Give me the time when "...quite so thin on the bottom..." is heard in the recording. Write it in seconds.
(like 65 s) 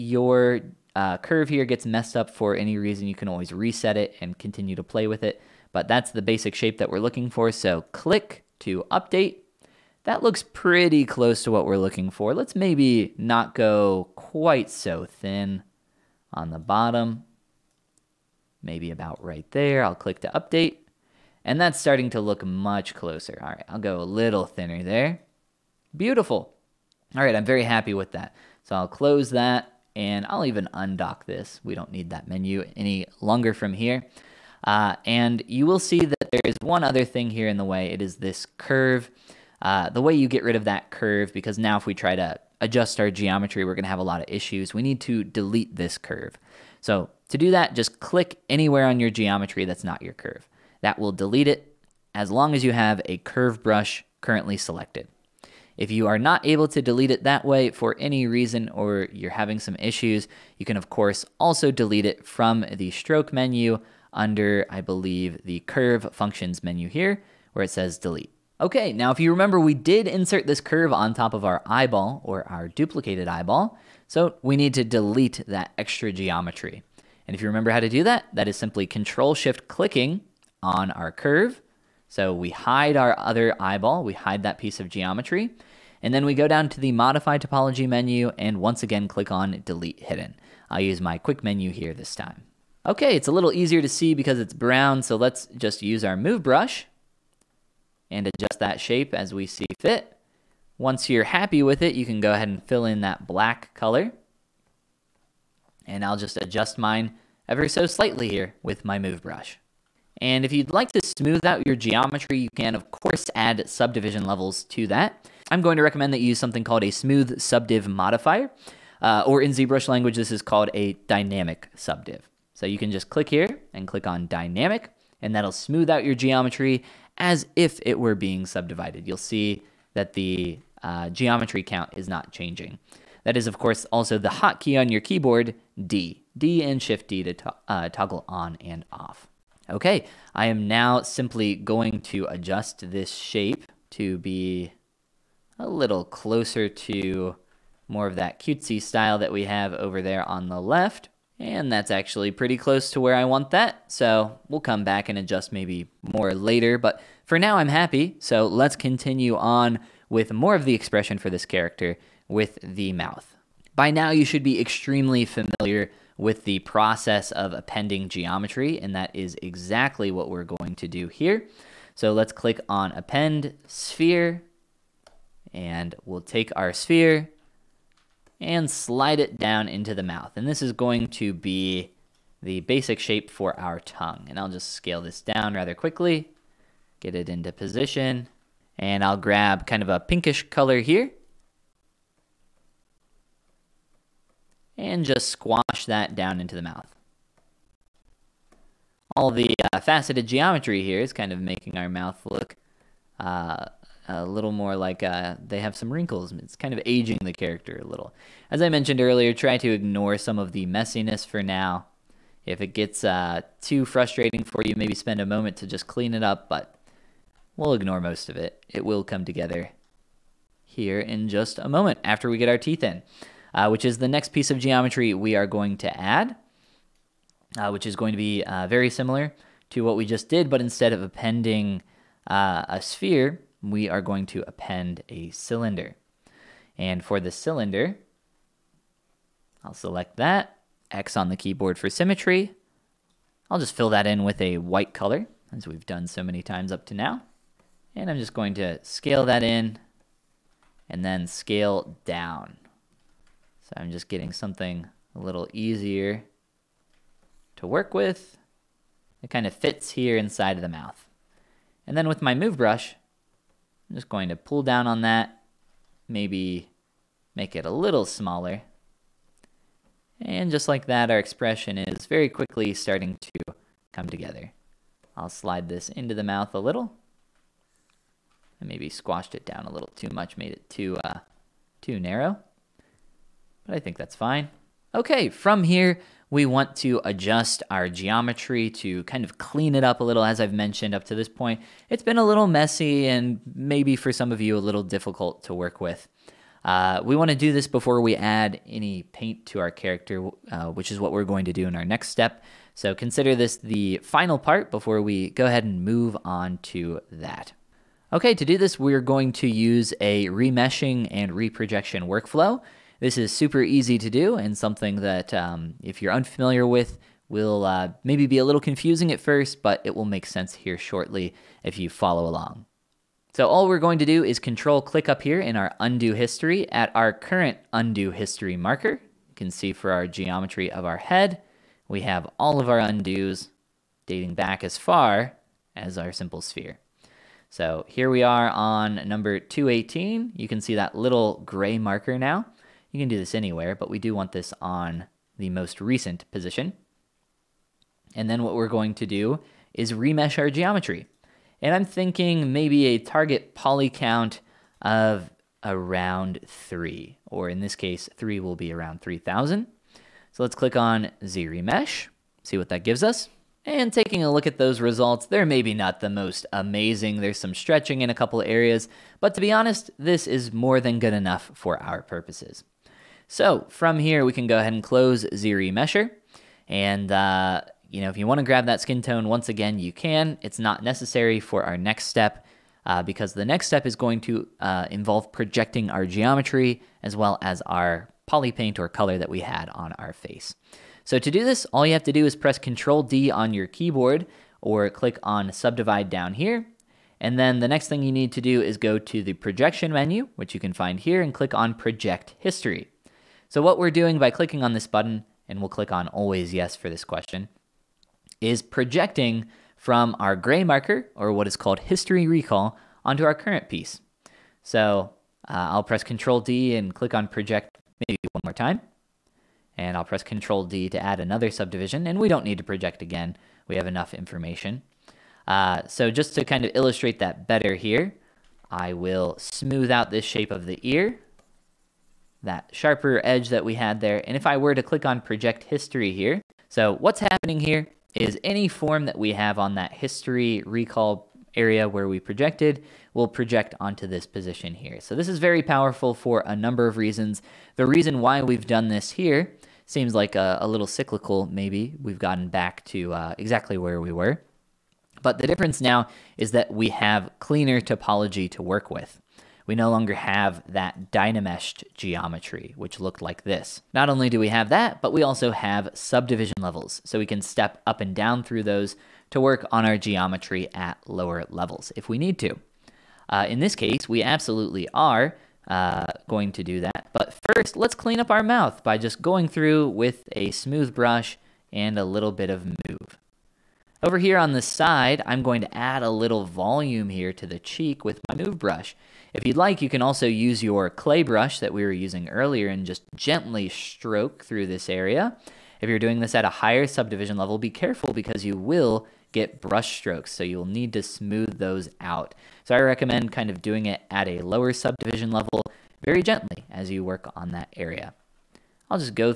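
14 s.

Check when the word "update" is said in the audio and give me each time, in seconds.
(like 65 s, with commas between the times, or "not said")
8 s, 20 s.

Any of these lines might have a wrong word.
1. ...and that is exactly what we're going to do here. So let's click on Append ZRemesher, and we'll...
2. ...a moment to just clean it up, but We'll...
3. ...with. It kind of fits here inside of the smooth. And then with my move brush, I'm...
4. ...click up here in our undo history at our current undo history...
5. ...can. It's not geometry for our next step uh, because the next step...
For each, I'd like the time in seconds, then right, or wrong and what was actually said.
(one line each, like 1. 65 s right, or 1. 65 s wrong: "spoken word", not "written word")
1. 168 s wrong: "Sphere", not "ZRemesher"
2. 215 s right
3. 257 s wrong: "mouth", not "smooth"
4. 324 s right
5. 379 s wrong: "necessary", not "geometry".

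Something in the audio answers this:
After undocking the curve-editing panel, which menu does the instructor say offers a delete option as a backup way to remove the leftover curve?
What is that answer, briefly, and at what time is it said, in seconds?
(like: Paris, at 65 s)
stroke menu, at 62 s.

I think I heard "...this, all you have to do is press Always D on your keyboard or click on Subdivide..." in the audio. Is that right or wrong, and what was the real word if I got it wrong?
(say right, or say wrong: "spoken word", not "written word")
wrong: "Control", not "Always".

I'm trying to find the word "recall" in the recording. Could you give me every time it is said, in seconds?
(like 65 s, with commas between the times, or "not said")
412 s, 440 s.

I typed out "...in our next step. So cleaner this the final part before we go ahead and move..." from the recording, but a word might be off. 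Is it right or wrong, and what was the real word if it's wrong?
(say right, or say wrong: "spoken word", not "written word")
wrong: "consider", not "cleaner".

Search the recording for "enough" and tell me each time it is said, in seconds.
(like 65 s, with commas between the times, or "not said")
371 s, 423 s.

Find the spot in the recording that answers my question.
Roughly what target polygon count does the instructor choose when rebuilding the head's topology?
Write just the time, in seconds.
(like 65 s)
359 s.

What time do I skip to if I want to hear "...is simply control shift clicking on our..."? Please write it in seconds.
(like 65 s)
78 s.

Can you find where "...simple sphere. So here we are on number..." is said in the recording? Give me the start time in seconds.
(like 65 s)
336 s.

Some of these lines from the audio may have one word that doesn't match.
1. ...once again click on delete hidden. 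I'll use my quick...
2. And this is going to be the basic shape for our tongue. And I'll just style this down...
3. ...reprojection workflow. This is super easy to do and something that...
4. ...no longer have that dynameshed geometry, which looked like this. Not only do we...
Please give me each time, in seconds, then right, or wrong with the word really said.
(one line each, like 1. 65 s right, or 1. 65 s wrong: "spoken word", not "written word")
1. 88 s right
2. 180 s wrong: "scale", not "style"
3. 311 s right
4. 459 s right.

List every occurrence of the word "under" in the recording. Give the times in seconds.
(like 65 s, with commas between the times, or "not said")
64 s.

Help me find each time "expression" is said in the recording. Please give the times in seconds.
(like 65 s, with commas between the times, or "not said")
160 s, 271 s.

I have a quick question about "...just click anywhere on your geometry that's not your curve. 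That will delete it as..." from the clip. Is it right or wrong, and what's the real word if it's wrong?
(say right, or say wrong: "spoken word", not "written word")
right.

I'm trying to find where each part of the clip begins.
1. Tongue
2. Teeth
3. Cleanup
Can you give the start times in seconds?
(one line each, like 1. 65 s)
1. 160 s
2. 220 s
3. 280 s.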